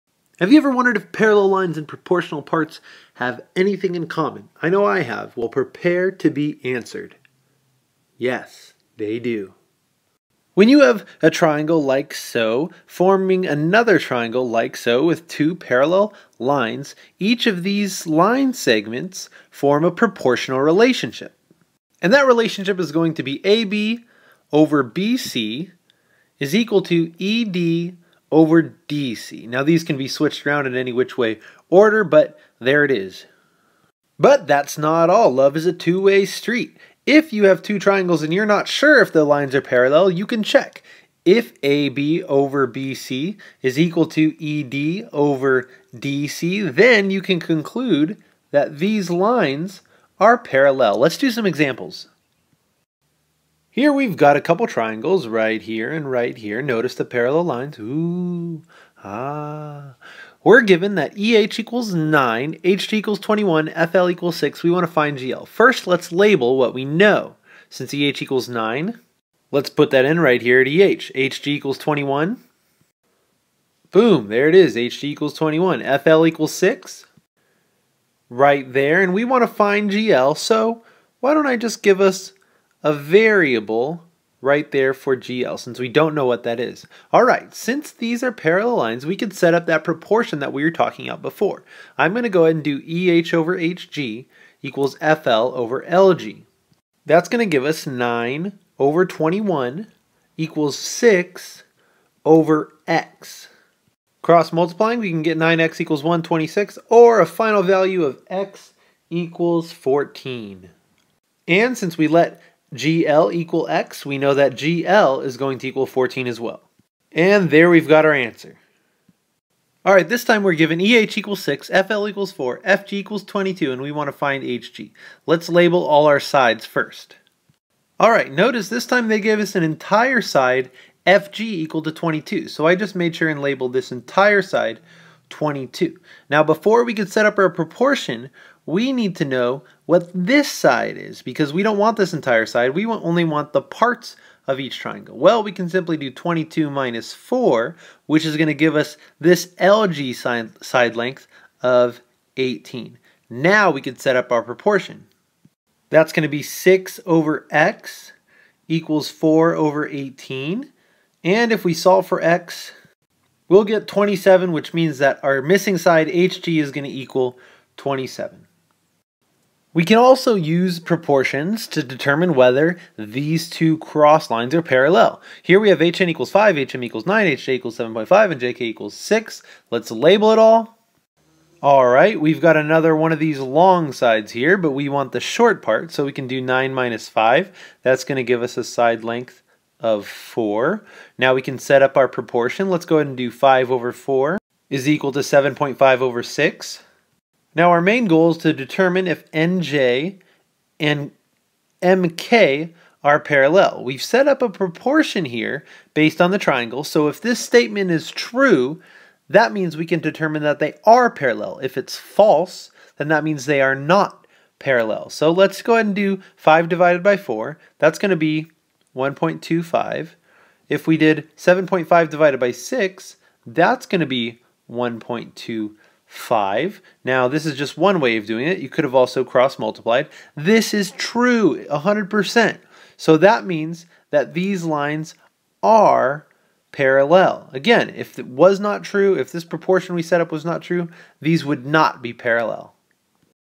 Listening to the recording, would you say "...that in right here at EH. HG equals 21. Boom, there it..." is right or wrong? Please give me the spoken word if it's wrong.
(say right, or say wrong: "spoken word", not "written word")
right.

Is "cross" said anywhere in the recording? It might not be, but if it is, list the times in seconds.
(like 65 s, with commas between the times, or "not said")
104 s, 173 s, 229 s.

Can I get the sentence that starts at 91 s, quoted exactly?
I'm going to go ahead and do EH over HG equals FL over LG.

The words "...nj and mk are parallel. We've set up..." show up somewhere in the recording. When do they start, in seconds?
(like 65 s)
199 s.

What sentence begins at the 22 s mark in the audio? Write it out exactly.
And that relationship is going to be AB over BC is equal to ED over DC.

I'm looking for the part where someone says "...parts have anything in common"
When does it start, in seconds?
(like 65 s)
2 s.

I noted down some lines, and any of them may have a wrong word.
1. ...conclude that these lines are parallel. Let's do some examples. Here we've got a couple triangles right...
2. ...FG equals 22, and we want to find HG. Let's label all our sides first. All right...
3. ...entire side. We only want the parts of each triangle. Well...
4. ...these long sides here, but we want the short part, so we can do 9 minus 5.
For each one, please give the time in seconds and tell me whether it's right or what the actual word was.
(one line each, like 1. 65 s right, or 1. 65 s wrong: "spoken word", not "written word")
1. 47 s right
2. 122 s right
3. 142 s right
4. 183 s right.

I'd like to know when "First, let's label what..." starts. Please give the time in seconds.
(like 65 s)
65 s.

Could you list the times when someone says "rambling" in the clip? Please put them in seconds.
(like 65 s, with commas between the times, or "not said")
not said.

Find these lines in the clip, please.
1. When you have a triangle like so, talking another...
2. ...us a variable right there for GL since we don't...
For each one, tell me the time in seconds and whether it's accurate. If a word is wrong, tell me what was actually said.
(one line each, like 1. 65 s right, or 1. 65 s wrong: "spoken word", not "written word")
1. 10 s wrong: "forming", not "talking"
2. 82 s right.